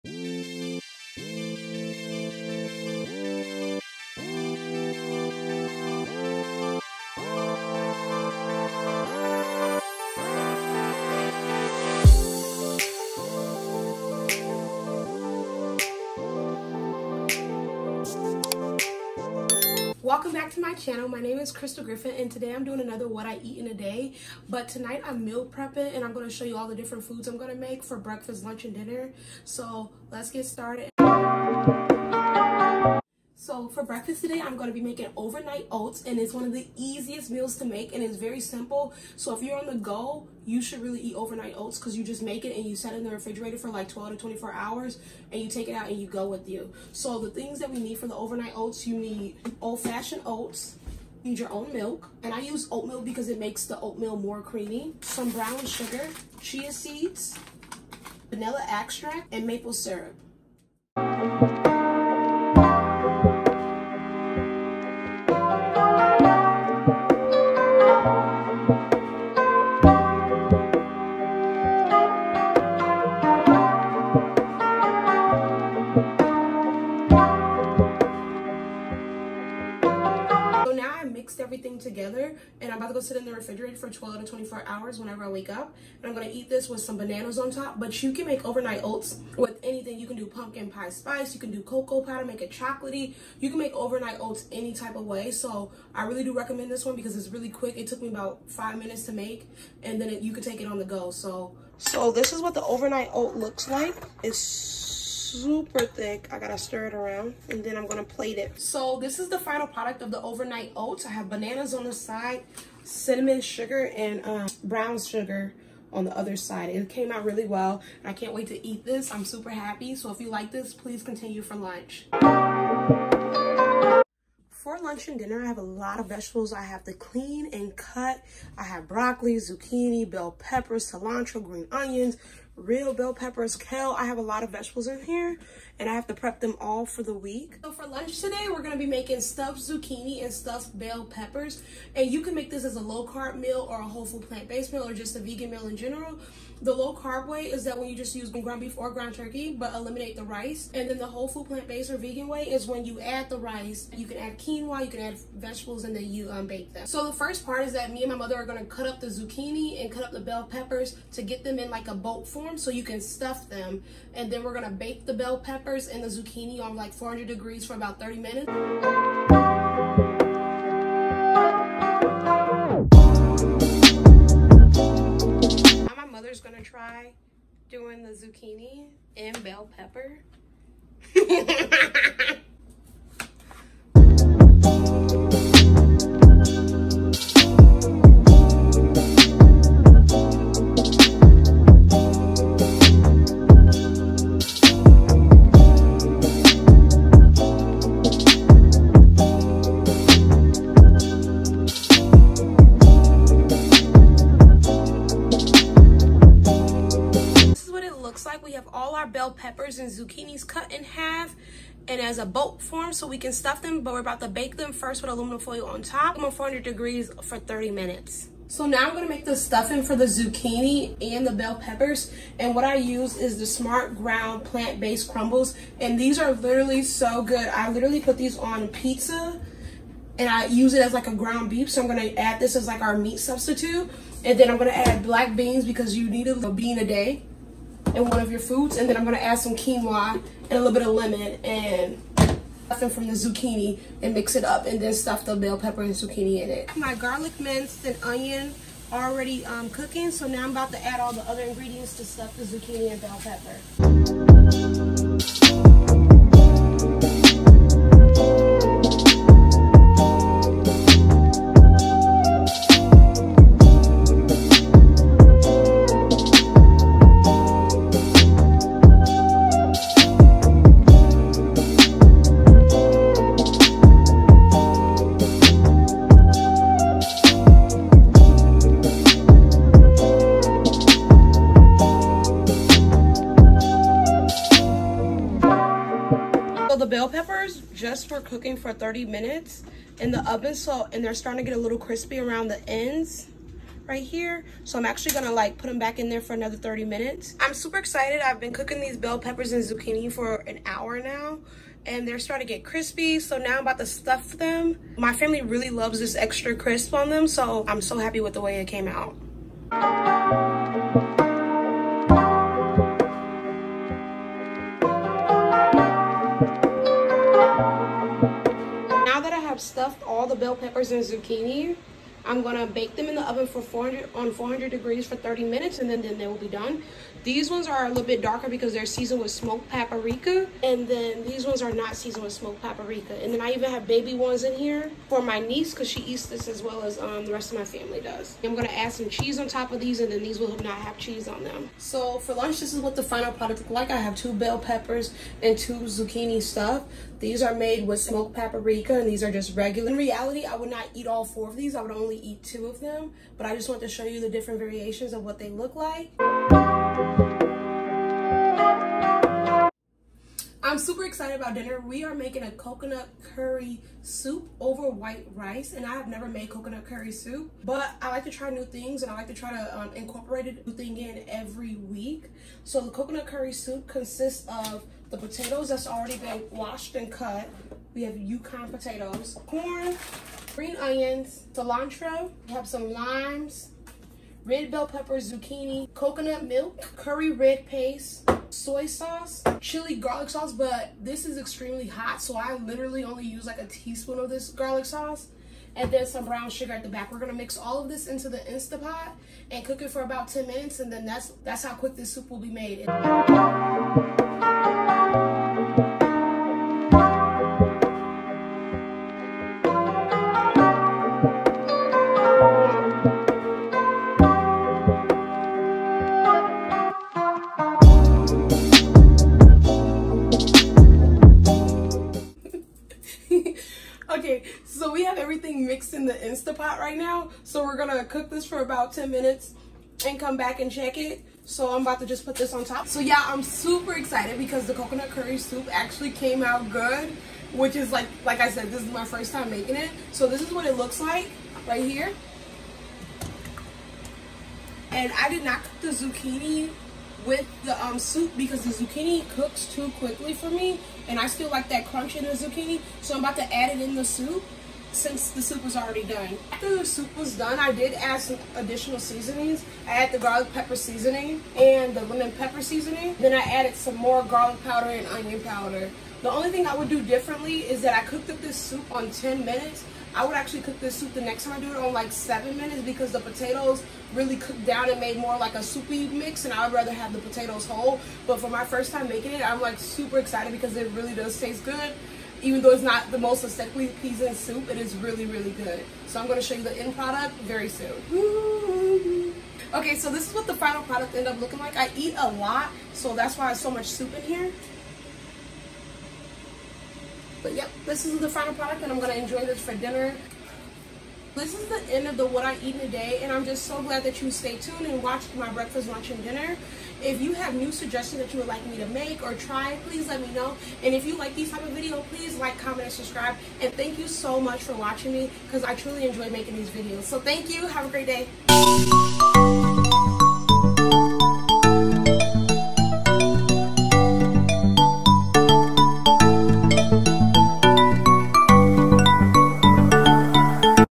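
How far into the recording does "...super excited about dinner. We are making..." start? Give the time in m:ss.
6:00.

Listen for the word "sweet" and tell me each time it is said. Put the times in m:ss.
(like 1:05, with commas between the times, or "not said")
not said.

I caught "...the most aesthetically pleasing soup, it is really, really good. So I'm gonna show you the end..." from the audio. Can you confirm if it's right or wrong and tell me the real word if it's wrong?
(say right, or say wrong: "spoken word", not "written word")
right.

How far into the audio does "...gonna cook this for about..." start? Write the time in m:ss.
7:07.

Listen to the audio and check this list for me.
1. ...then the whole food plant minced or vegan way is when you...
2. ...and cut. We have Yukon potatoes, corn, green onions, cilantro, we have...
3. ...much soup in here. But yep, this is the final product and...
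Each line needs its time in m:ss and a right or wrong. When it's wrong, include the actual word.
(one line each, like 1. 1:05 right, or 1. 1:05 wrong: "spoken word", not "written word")
1. 2:30 wrong: "based", not "minced"
2. 6:16 right
3. 8:13 right.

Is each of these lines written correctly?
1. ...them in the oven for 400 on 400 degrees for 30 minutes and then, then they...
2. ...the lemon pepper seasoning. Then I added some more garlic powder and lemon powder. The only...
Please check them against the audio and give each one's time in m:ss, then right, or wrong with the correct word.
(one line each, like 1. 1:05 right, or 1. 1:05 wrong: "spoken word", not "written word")
1. 5:22 right
2. 7:41 wrong: "onion", not "lemon".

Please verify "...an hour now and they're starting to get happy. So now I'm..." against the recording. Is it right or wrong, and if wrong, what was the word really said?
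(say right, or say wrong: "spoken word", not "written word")
wrong: "crispy", not "happy".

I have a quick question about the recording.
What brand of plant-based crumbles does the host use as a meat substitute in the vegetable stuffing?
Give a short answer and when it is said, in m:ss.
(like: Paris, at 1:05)
Smart Ground, at 3:43.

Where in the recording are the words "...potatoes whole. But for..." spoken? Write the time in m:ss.
7:57.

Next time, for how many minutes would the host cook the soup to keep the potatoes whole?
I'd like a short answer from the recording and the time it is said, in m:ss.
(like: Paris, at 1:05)
7, at 7:52.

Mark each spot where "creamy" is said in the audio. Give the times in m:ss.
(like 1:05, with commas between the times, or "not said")
0:54.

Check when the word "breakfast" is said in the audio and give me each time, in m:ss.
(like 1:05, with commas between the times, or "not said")
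0:27, 0:33, 8:25.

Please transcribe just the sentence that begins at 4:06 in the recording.
My garlic minced and onion already um, cooking.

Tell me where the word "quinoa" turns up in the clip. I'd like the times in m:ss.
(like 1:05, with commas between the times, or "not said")
2:34, 3:59.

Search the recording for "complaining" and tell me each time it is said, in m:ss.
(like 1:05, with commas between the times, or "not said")
not said.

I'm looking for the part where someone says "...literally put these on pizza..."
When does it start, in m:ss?
3:47.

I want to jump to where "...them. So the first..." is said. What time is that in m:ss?
2:36.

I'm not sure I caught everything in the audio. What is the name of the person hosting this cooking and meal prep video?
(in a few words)
Crystal Griffin.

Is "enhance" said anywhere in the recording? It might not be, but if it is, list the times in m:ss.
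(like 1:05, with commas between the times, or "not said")
not said.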